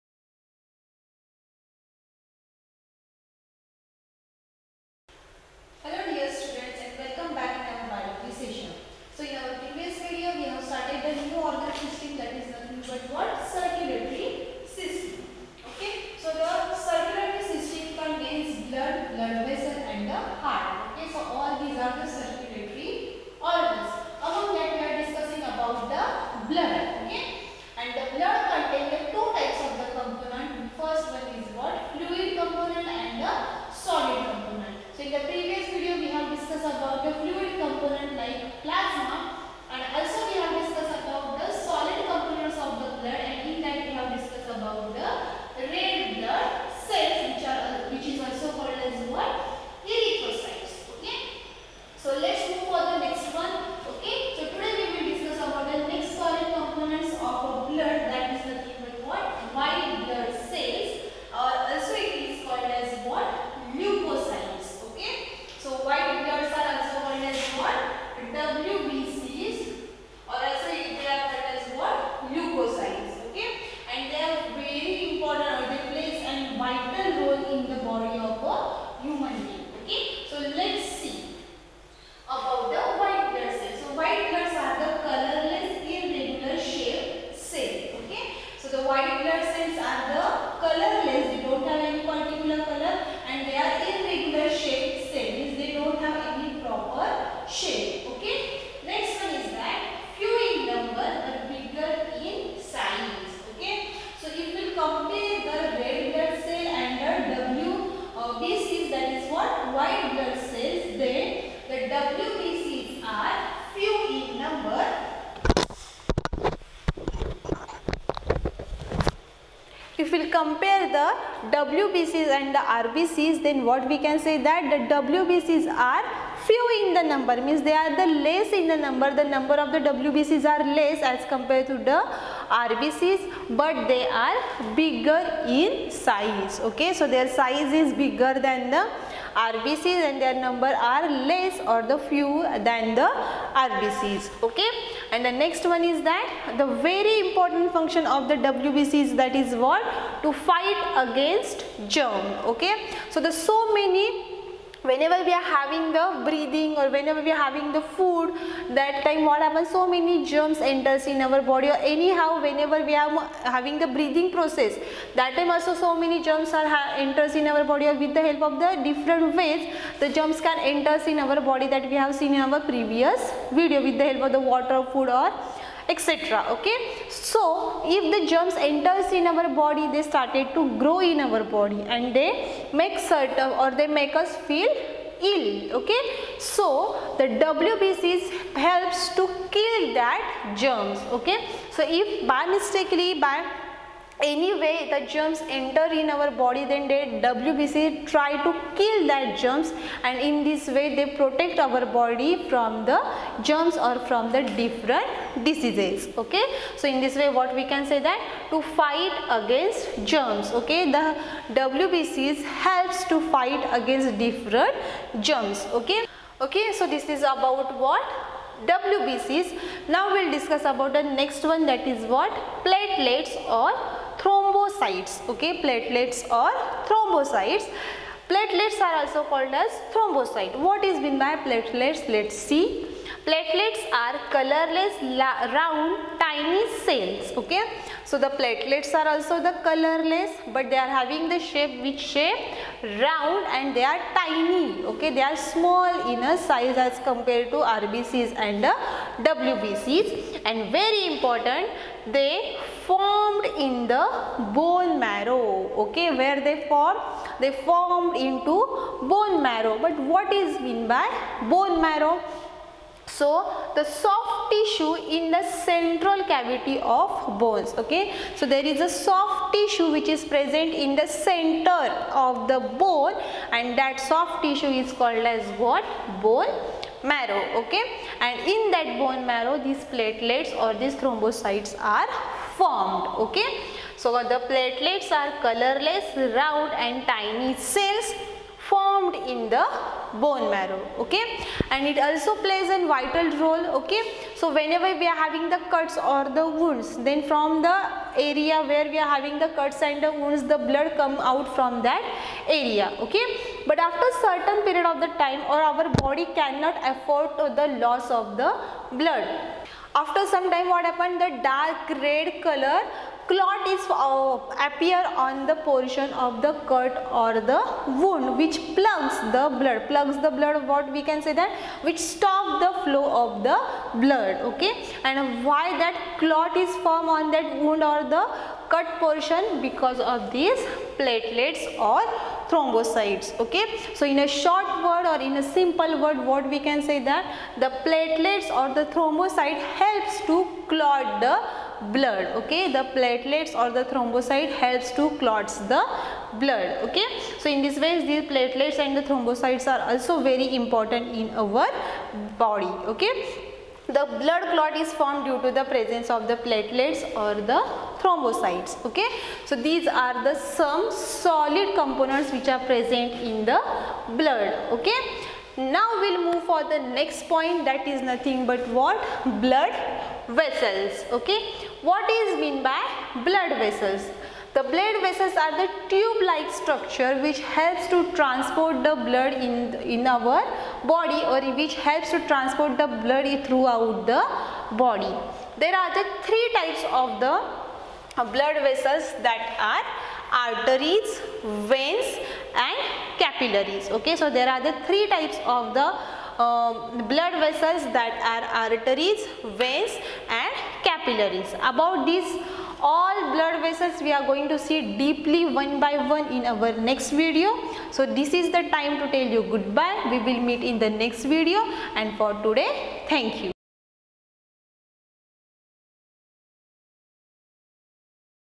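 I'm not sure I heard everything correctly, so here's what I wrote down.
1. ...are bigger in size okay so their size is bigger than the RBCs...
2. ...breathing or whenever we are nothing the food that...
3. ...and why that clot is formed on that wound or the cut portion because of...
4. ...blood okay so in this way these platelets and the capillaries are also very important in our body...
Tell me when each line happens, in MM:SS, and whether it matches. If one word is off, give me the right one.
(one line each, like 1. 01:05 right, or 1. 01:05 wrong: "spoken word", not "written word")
1. 02:14 right
2. 02:36 wrong: "having", not "nothing"
3. 05:25 right
4. 05:46 wrong: "thrombocytes", not "capillaries".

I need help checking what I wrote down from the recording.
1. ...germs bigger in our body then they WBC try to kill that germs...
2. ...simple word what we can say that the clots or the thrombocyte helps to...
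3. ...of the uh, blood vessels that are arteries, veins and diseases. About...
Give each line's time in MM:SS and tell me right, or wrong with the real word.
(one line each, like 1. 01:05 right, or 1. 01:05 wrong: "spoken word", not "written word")
1. 03:15 wrong: "enter", not "bigger"
2. 05:35 wrong: "platelets", not "clots"
3. 06:35 wrong: "capillaries", not "diseases".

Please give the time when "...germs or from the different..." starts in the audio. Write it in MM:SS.
03:23.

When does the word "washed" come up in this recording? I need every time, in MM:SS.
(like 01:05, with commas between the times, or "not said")
not said.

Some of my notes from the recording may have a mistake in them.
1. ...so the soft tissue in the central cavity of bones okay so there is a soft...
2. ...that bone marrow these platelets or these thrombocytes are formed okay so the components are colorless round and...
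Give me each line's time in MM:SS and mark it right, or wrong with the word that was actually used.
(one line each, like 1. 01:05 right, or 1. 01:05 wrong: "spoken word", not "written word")
1. 04:23 right
2. 04:38 wrong: "platelets", not "components".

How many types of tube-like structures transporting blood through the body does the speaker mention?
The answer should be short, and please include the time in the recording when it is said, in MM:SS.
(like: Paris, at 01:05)
3, at 06:26.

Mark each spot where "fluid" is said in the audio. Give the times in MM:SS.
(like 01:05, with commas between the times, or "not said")
00:31, 00:37.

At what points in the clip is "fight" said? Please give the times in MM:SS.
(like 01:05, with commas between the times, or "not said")
02:30, 03:28, 03:33.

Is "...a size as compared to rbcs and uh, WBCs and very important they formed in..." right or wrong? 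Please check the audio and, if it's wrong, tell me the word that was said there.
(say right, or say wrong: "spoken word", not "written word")
right.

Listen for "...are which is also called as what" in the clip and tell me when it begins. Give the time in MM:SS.
00:47.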